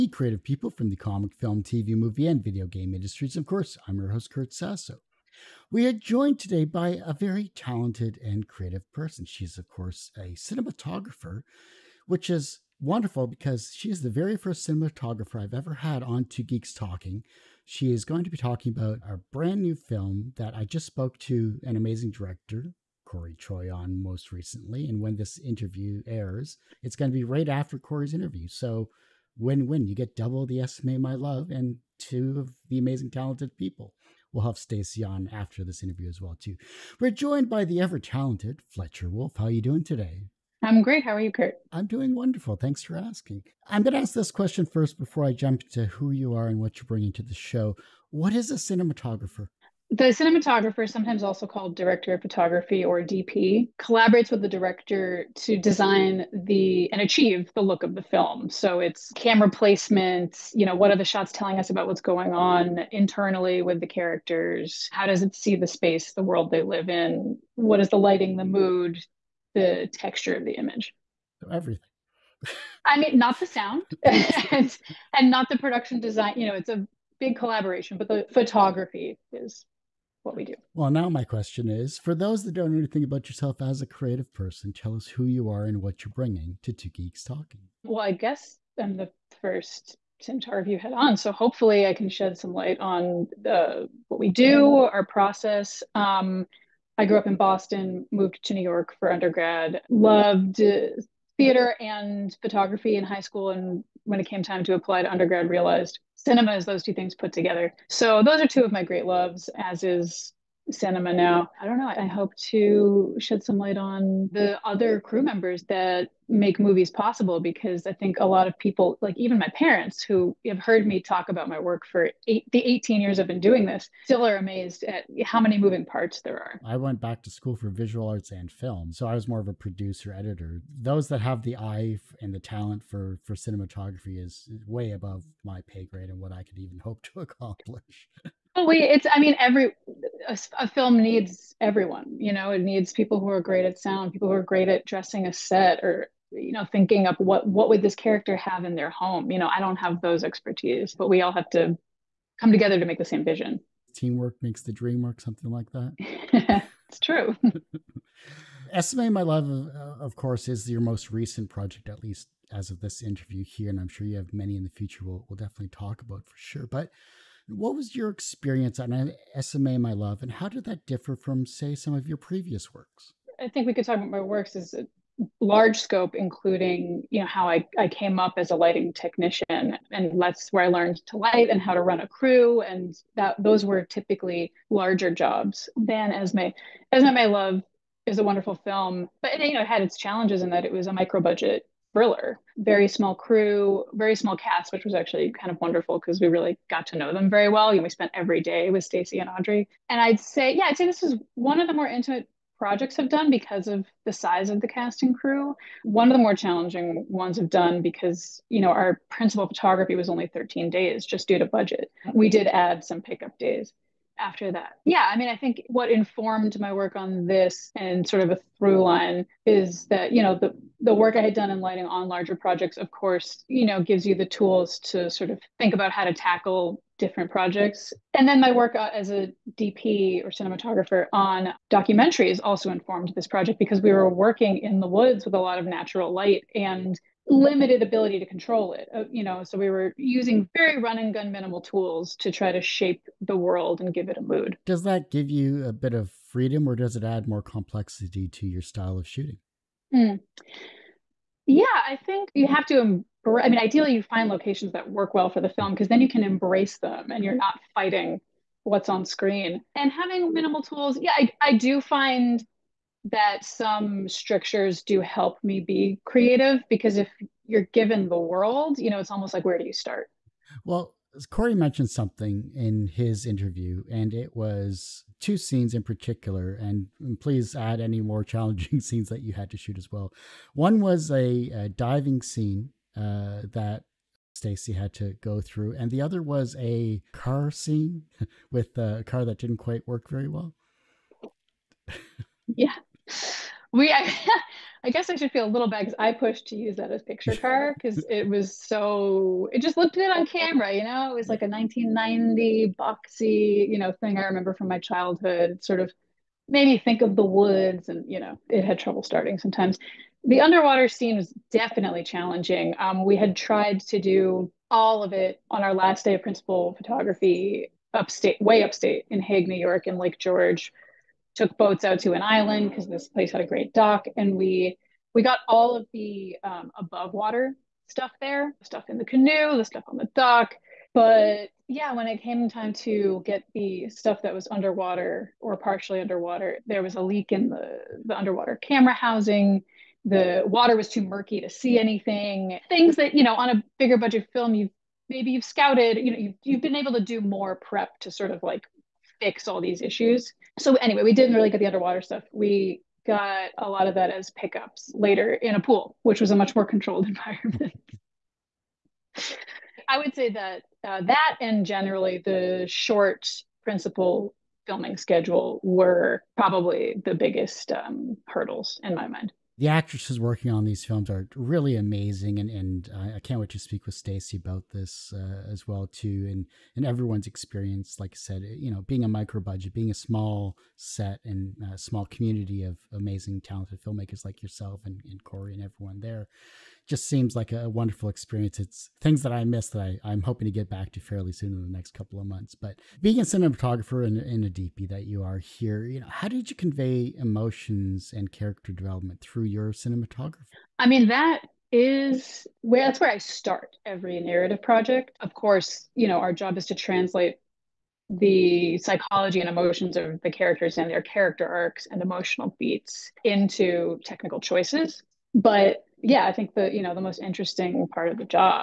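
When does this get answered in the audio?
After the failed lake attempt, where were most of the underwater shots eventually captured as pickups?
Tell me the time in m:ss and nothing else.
5:55.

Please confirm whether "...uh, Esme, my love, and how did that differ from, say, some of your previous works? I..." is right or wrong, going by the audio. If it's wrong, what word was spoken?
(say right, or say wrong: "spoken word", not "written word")
right.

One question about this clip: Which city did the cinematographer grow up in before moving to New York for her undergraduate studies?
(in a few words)
Boston.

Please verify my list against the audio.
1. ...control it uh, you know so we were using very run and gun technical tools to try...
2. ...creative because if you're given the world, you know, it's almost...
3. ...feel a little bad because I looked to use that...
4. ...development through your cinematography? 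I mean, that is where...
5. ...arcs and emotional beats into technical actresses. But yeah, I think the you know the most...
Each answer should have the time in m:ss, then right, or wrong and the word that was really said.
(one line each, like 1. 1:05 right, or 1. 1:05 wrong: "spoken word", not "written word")
1. 3:58 wrong: "minimal", not "technical"
2. 4:26 right
3. 4:55 wrong: "pushed", not "looked"
4. 6:38 right
5. 6:51 wrong: "choices", not "actresses".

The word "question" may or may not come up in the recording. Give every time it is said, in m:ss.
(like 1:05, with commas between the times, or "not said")
0:44, 1:21.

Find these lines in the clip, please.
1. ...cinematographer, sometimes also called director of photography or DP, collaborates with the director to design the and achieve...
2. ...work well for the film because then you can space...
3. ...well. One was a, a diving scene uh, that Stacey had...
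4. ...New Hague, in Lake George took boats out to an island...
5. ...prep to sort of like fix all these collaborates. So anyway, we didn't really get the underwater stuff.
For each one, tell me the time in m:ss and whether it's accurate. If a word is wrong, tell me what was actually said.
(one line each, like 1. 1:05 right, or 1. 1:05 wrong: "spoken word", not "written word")
1. 0:50 right
2. 4:14 wrong: "embrace", not "space"
3. 4:39 right
4. 5:19 wrong: "York", not "Hague"
5. 5:47 wrong: "issues", not "collaborates".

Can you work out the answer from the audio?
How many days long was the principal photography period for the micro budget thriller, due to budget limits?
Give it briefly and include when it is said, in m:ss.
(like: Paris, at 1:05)
13, at 3:30.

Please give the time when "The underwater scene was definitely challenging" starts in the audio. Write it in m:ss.
5:10.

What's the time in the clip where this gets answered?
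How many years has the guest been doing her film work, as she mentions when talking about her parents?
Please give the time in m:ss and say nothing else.
2:02.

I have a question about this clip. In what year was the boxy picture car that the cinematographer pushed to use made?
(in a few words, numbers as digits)
1990.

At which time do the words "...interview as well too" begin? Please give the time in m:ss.
0:35.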